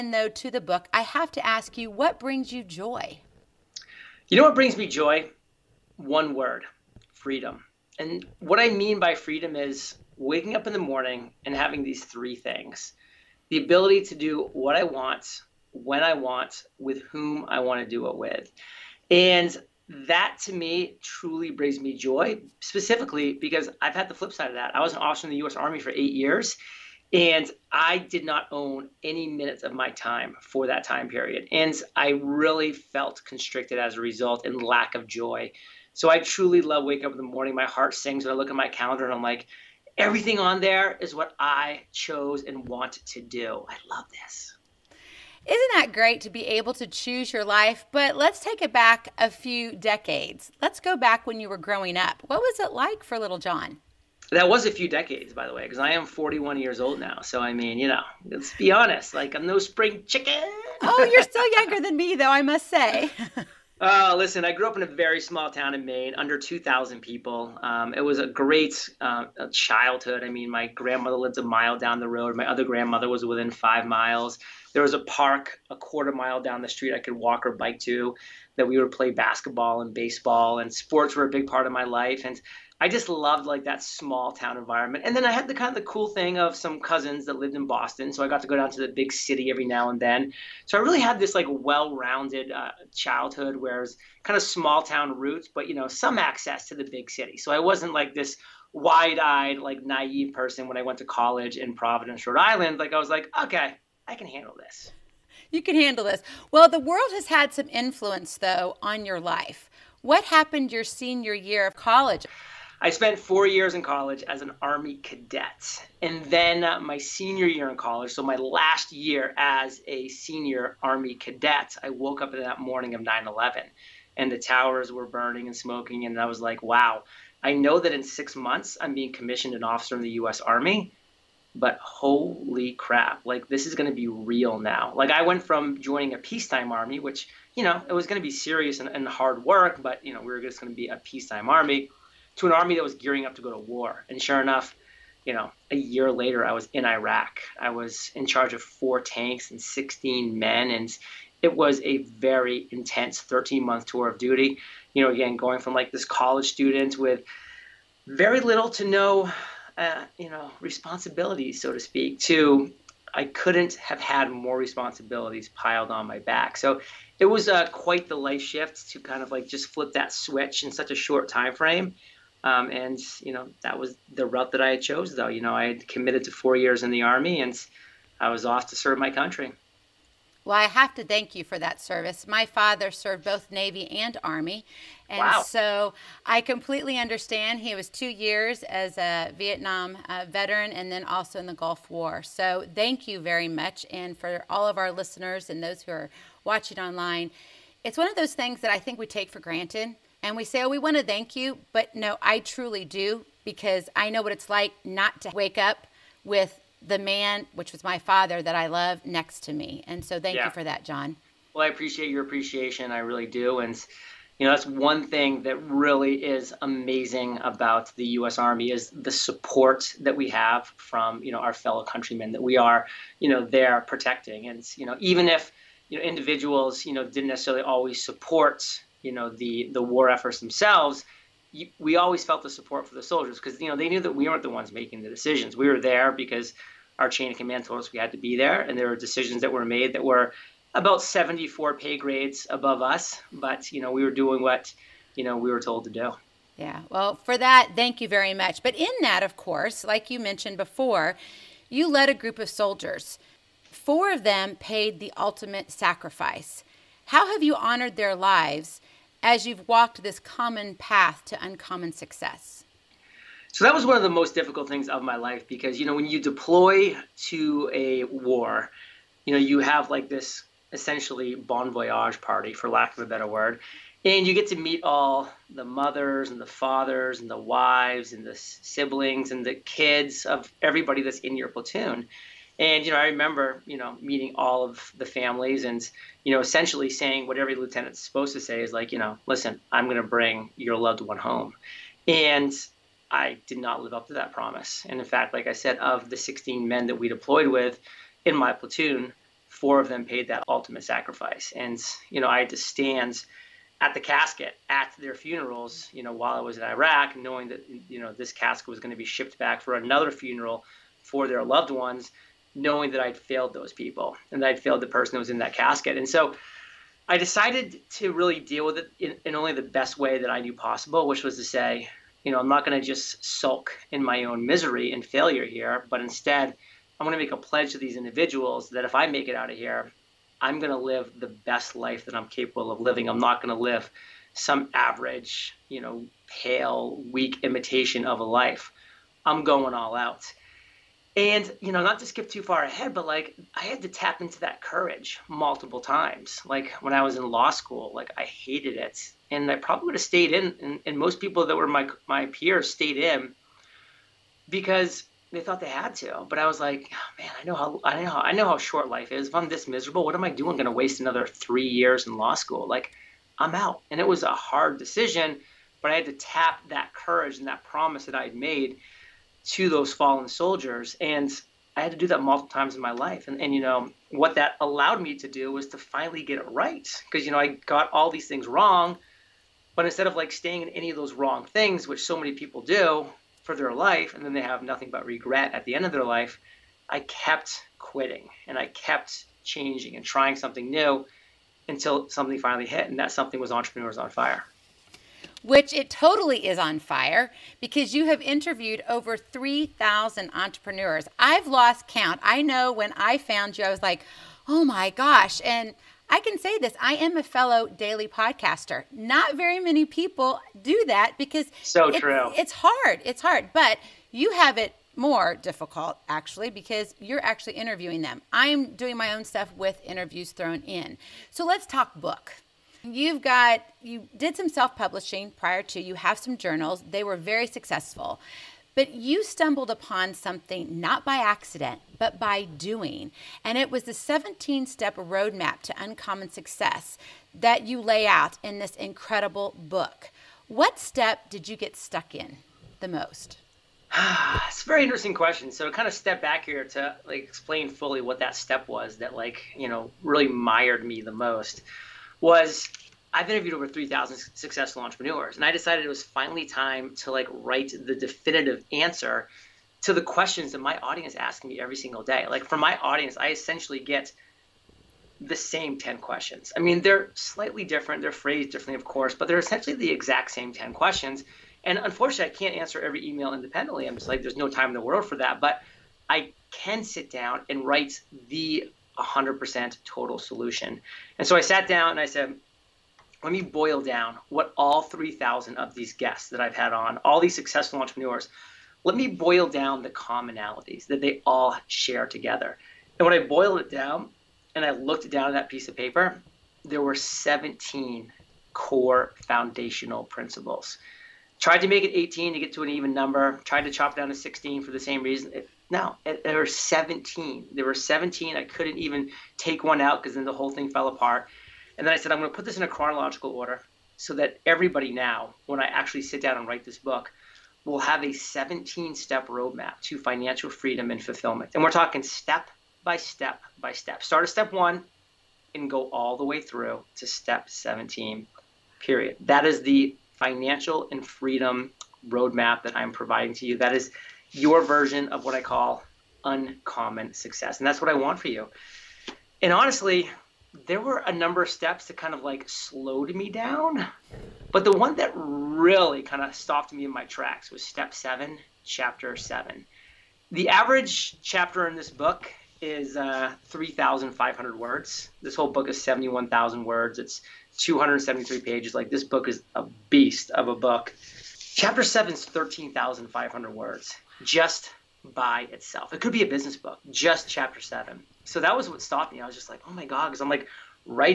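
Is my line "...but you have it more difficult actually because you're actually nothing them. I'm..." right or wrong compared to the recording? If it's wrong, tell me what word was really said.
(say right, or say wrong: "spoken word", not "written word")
wrong: "interviewing", not "nothing".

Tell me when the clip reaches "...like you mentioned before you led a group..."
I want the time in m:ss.
4:09.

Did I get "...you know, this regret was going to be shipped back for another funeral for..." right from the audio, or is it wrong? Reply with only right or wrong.
wrong.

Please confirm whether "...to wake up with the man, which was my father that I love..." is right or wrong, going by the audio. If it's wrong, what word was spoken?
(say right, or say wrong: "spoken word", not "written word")
right.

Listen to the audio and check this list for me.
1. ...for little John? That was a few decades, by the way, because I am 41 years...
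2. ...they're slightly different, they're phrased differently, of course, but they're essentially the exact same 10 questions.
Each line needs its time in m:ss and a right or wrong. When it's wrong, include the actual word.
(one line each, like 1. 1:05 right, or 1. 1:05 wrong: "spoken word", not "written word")
1. 0:53 right
2. 7:46 right.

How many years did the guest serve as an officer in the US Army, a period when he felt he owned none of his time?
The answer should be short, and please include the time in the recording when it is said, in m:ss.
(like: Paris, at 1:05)
8, at 0:25.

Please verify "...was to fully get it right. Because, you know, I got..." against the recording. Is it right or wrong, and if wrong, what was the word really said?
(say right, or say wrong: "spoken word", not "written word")
wrong: "finally", not "fully".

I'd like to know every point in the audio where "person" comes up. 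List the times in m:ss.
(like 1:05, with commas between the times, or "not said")
1:40, 5:14.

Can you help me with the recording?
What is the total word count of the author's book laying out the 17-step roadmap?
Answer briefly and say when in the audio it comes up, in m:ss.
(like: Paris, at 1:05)
71,000, at 9:15.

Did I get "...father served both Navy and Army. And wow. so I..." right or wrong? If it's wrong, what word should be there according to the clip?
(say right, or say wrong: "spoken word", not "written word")
right.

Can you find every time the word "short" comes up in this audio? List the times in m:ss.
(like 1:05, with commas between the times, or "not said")
2:50, 5:58.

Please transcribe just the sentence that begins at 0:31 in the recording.
And I really felt constricted as a result and lack of joy so I truly love waking up in the morning.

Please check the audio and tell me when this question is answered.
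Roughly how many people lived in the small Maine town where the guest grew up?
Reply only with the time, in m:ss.
1:06.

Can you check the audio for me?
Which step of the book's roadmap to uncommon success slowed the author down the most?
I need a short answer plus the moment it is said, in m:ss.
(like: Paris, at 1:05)
Step 7, at 9:07.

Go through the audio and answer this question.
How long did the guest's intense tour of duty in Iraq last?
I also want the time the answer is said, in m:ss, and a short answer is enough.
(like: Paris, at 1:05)
13 months, at 2:33.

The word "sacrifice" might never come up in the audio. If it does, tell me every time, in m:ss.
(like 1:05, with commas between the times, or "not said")
4:15, 5:00.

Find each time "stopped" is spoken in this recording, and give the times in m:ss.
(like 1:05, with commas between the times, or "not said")
9:06, 9:28.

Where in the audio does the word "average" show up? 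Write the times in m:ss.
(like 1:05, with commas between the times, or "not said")
5:34, 9:10.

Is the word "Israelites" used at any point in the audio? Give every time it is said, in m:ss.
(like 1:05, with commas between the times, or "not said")
not said.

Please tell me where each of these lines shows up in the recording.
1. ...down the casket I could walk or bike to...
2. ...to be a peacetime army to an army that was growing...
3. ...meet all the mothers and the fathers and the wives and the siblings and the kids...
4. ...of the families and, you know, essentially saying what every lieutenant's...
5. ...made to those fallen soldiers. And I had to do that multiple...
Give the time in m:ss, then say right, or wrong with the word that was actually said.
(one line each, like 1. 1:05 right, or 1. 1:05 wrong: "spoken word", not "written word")
1. 1:16 wrong: "street", not "casket"
2. 2:20 wrong: "gearing", not "growing"
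3. 4:34 right
4. 4:44 right
5. 6:08 right.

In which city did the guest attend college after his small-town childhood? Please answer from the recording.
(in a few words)
Providence, Rhode Island.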